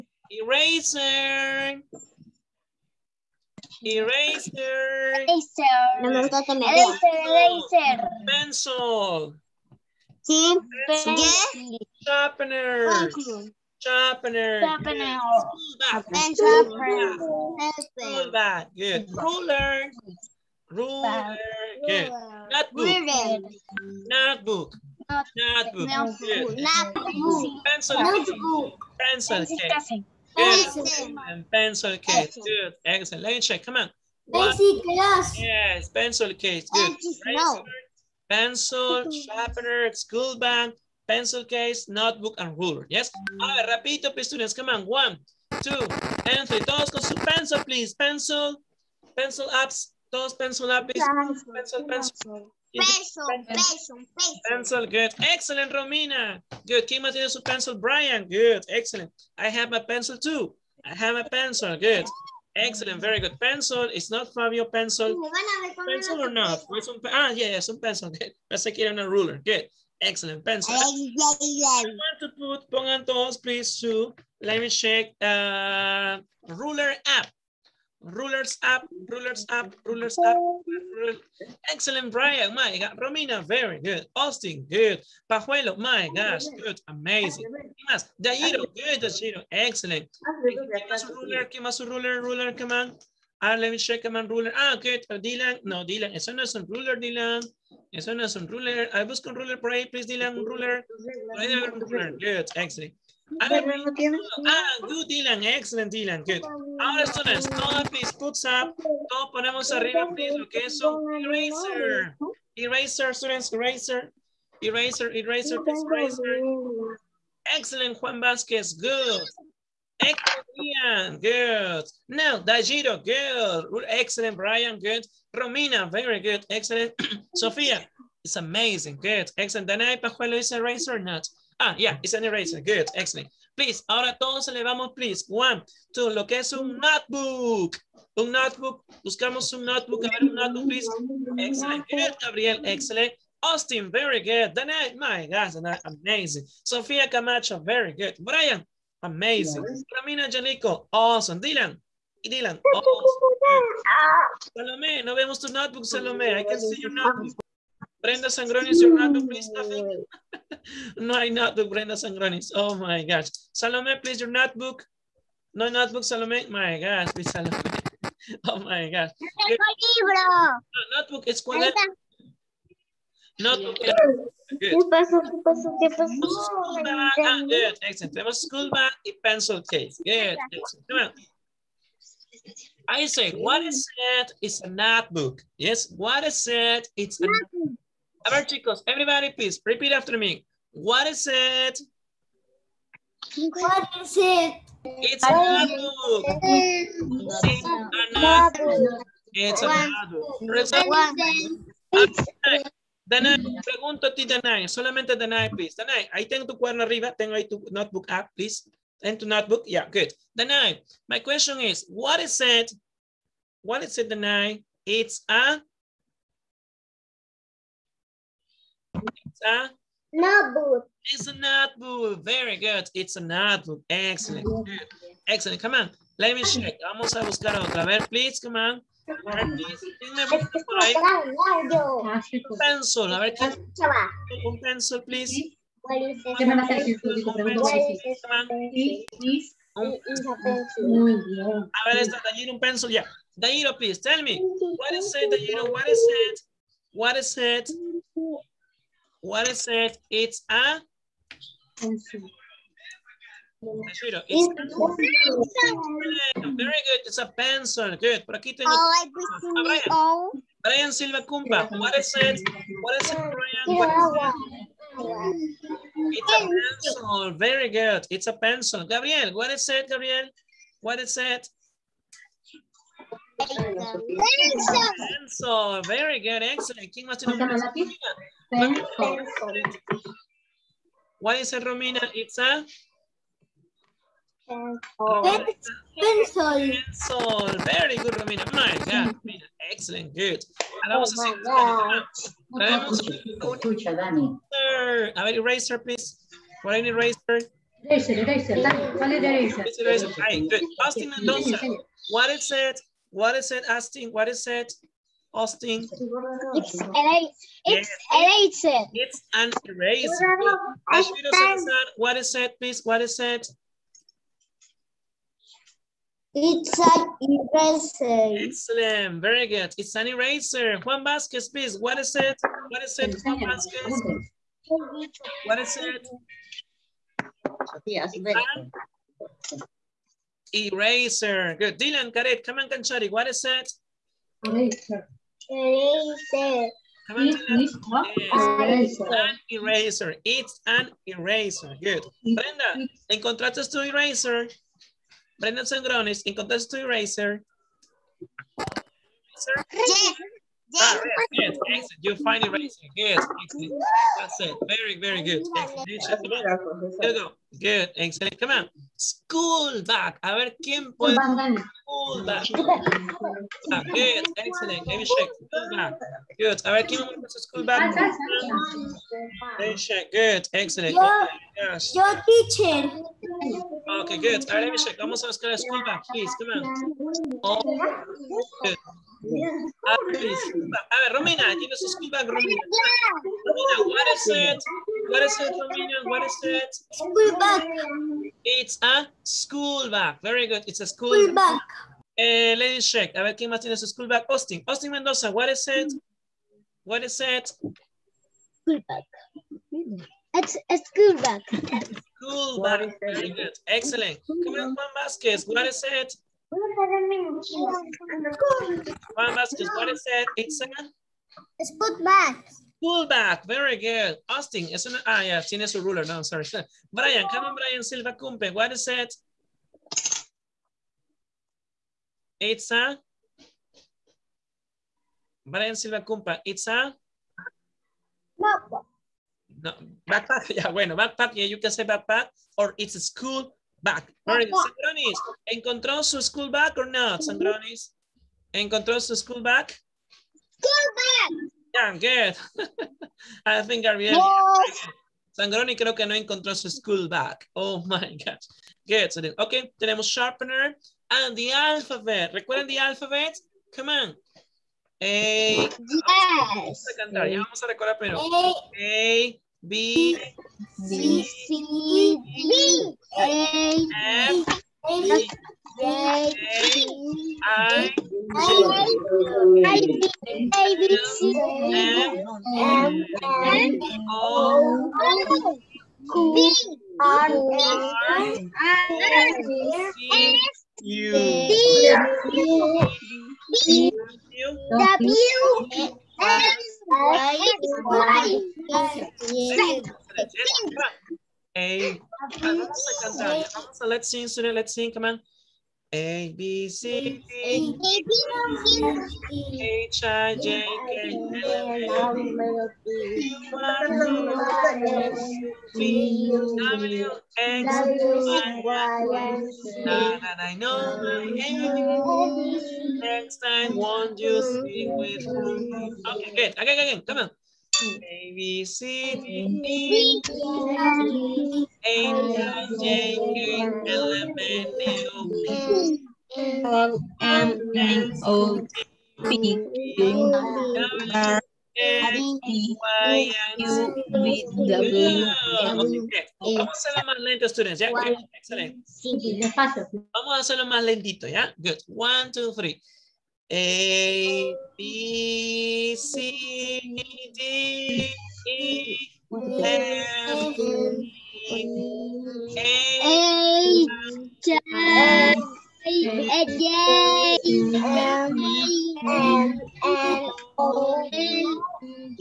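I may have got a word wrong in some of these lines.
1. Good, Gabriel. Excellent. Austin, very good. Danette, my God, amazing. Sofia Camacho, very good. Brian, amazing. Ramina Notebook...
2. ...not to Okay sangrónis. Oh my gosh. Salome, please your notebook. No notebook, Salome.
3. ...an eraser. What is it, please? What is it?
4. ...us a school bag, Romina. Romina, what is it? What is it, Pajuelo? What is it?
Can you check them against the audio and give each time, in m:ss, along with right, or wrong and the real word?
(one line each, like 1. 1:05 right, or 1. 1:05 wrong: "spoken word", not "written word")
1. 2:21 wrong: "Janico", not "Notebook"
2. 2:41 wrong: "Brenda", not "Okay"
3. 5:09 right
4. 6:21 wrong: "Romina", not "Pajuelo".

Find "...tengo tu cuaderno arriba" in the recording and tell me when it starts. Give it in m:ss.
3:26.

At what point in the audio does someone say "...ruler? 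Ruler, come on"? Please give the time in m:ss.
1:31.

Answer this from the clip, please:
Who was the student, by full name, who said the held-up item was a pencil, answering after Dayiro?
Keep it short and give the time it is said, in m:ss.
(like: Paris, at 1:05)
Brian Silva Cumba, at 4:20.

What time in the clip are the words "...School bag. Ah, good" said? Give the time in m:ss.
2:54.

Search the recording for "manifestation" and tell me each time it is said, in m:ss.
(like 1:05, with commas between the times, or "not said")
not said.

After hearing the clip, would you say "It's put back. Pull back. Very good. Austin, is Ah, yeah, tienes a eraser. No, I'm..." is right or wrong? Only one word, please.
wrong.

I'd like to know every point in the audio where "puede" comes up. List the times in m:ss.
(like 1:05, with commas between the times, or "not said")
6:00, 6:07.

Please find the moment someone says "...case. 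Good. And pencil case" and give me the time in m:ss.
0:29.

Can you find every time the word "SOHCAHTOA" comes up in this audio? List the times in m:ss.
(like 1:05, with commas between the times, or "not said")
not said.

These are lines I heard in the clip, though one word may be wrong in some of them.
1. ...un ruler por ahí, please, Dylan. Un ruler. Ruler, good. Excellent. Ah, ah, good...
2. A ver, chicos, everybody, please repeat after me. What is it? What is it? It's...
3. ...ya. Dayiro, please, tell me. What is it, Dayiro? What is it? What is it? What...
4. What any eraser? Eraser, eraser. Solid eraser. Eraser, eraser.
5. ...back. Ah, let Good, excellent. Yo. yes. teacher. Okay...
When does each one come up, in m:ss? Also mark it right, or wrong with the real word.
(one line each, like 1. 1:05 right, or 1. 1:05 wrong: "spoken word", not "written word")
1. 1:39 right
2. 3:08 right
3. 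4:02 right
4. 4:56 right
5. 6:07 right.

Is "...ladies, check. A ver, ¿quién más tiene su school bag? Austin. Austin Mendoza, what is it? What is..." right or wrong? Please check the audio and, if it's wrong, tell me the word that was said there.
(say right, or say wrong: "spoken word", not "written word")
right.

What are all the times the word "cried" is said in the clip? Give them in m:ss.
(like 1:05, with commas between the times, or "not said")
not said.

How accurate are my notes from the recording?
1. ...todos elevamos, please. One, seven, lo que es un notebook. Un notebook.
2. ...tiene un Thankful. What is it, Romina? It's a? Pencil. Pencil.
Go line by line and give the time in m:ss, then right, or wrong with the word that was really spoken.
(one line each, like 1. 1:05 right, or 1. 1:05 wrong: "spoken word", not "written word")
1. 2:14 wrong: "two", not "seven"
2. 4:37 right.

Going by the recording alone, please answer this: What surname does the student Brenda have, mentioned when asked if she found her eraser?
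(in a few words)
Sangrones.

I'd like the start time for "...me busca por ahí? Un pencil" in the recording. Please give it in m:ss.
3:50.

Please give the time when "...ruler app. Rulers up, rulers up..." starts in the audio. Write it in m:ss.
1:16.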